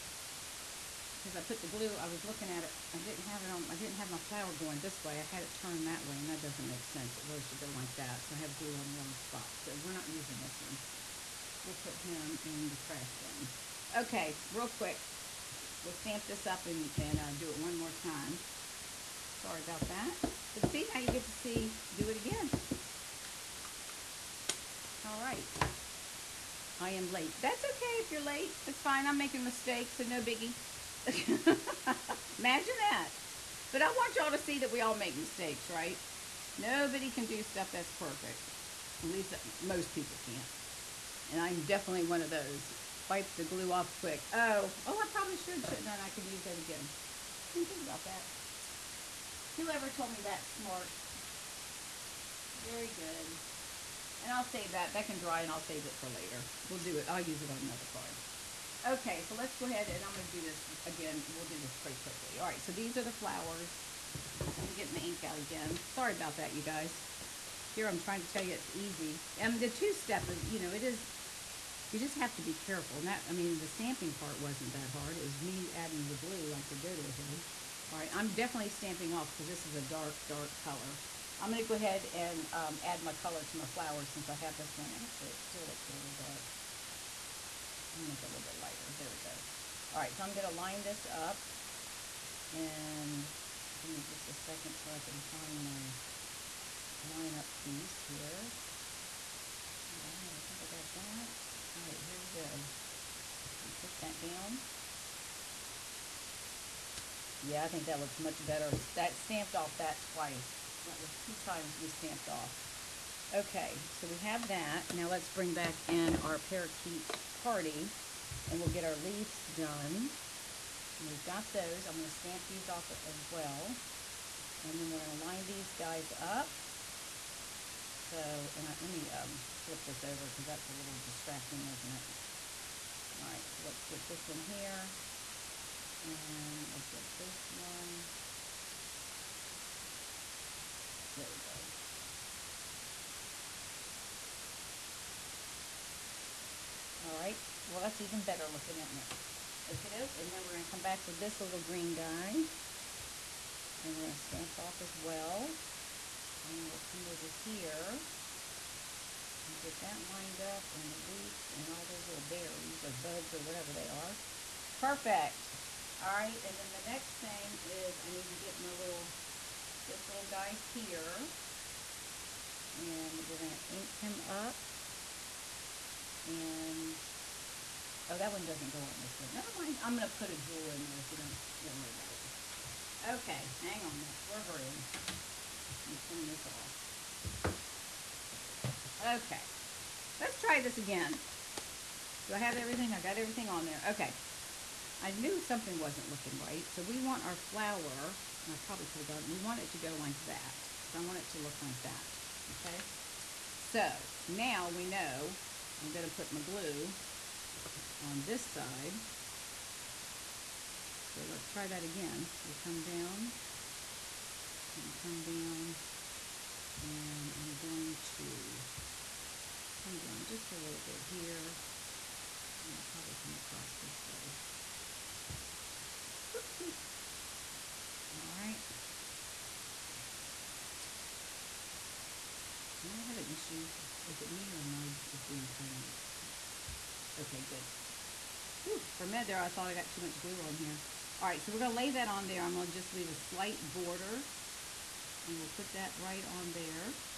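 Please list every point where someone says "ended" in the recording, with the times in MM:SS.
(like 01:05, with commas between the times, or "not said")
not said.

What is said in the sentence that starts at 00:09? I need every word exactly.
So we're not using this one.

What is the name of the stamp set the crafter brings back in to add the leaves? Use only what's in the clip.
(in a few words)
Parakeet Party.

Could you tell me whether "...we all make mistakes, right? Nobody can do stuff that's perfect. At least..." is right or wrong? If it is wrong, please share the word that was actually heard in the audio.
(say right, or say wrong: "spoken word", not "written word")
right.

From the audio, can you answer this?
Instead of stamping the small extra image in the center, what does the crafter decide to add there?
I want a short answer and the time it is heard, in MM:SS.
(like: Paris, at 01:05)
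A jewel, at 03:00.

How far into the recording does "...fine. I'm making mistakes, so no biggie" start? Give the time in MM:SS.
00:28.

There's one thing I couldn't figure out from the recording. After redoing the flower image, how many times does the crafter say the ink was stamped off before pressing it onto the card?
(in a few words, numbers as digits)
2.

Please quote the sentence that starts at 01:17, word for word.
All right, I'm definitely stamping off because this is a dark, dark color.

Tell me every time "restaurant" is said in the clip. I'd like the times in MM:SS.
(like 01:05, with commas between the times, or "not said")
not said.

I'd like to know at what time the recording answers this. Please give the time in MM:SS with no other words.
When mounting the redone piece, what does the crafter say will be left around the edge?
04:03.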